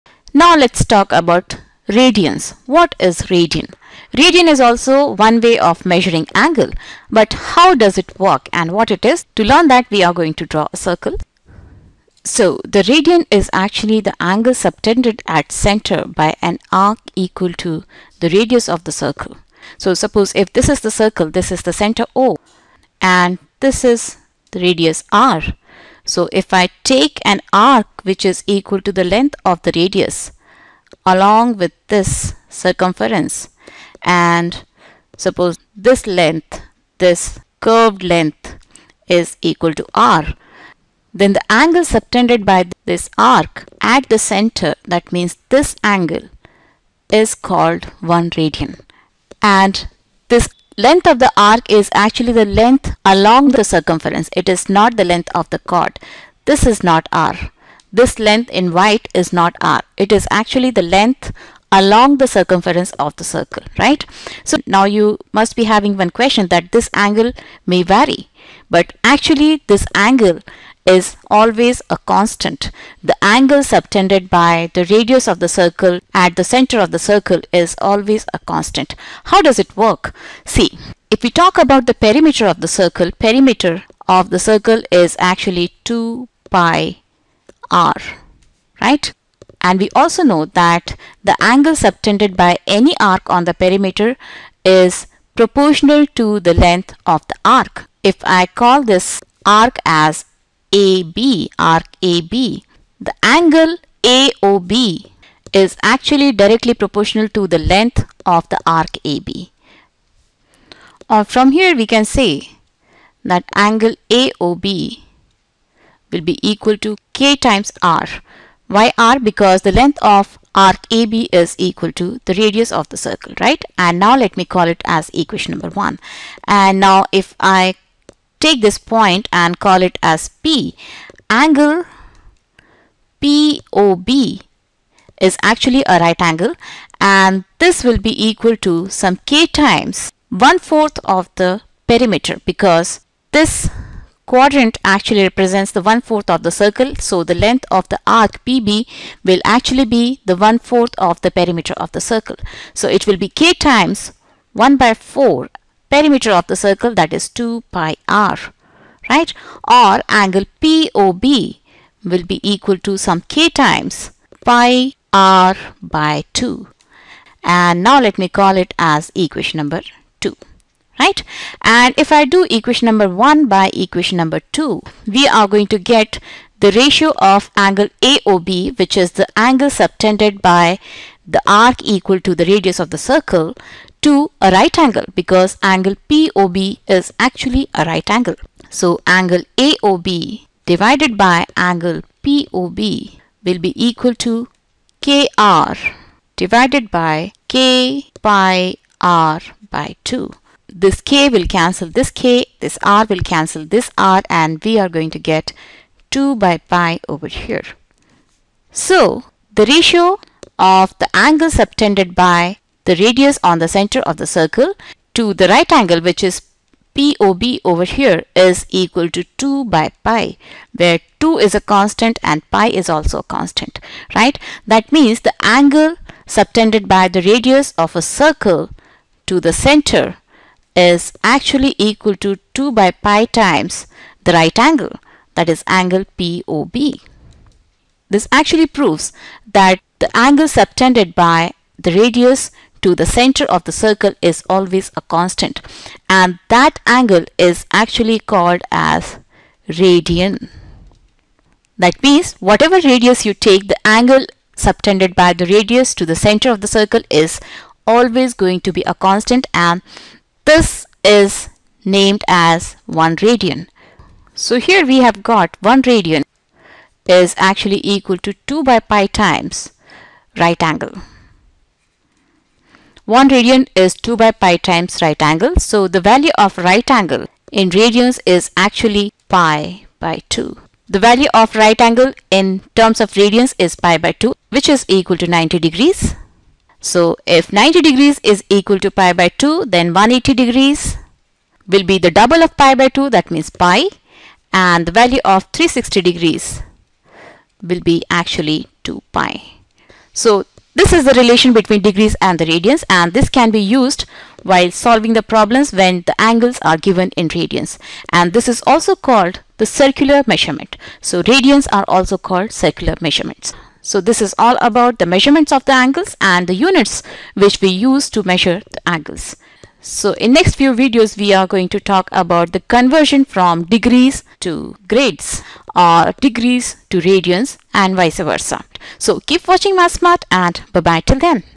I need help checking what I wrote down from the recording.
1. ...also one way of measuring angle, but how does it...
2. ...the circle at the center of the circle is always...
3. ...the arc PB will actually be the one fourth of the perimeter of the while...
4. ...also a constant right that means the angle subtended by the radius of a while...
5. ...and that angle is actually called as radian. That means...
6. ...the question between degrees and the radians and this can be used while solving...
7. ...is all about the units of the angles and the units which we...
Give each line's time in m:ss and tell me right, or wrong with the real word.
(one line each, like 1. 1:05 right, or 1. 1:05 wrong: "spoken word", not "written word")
1. 0:04 right
2. 1:15 right
3. 2:27 wrong: "circle", not "while"
4. 3:42 wrong: "circle", not "while"
5. 4:06 right
6. 5:01 wrong: "relation", not "question"
7. 5:14 wrong: "measurements", not "units".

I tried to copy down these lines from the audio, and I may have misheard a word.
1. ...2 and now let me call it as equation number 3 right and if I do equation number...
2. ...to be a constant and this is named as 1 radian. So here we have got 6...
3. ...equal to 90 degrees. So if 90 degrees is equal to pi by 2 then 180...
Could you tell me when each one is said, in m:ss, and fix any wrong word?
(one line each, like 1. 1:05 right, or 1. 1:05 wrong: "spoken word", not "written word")
1. 2:46 wrong: "2", not "3"
2. 4:18 wrong: "1", not "6"
3. 4:44 right.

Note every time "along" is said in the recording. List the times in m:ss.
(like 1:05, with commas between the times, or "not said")
0:31, 0:53, 1:01.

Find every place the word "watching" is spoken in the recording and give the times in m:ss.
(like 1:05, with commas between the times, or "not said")
5:29.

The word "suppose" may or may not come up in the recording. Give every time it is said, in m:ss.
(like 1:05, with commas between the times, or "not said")
0:19, 0:35.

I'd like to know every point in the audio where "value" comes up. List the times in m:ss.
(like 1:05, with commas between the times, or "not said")
4:35, 4:41, 4:55.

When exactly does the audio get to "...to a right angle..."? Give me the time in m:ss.
3:04.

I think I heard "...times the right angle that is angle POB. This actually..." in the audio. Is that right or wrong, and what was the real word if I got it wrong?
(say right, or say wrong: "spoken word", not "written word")
right.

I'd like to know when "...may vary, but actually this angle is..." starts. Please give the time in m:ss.
1:07.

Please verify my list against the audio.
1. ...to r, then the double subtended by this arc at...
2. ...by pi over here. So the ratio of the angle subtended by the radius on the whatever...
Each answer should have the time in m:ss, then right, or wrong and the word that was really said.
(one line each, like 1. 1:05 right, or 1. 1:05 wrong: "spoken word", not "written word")
1. 0:39 wrong: "angle", not "double"
2. 3:26 wrong: "center", not "whatever".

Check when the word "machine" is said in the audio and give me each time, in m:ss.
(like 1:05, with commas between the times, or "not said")
not said.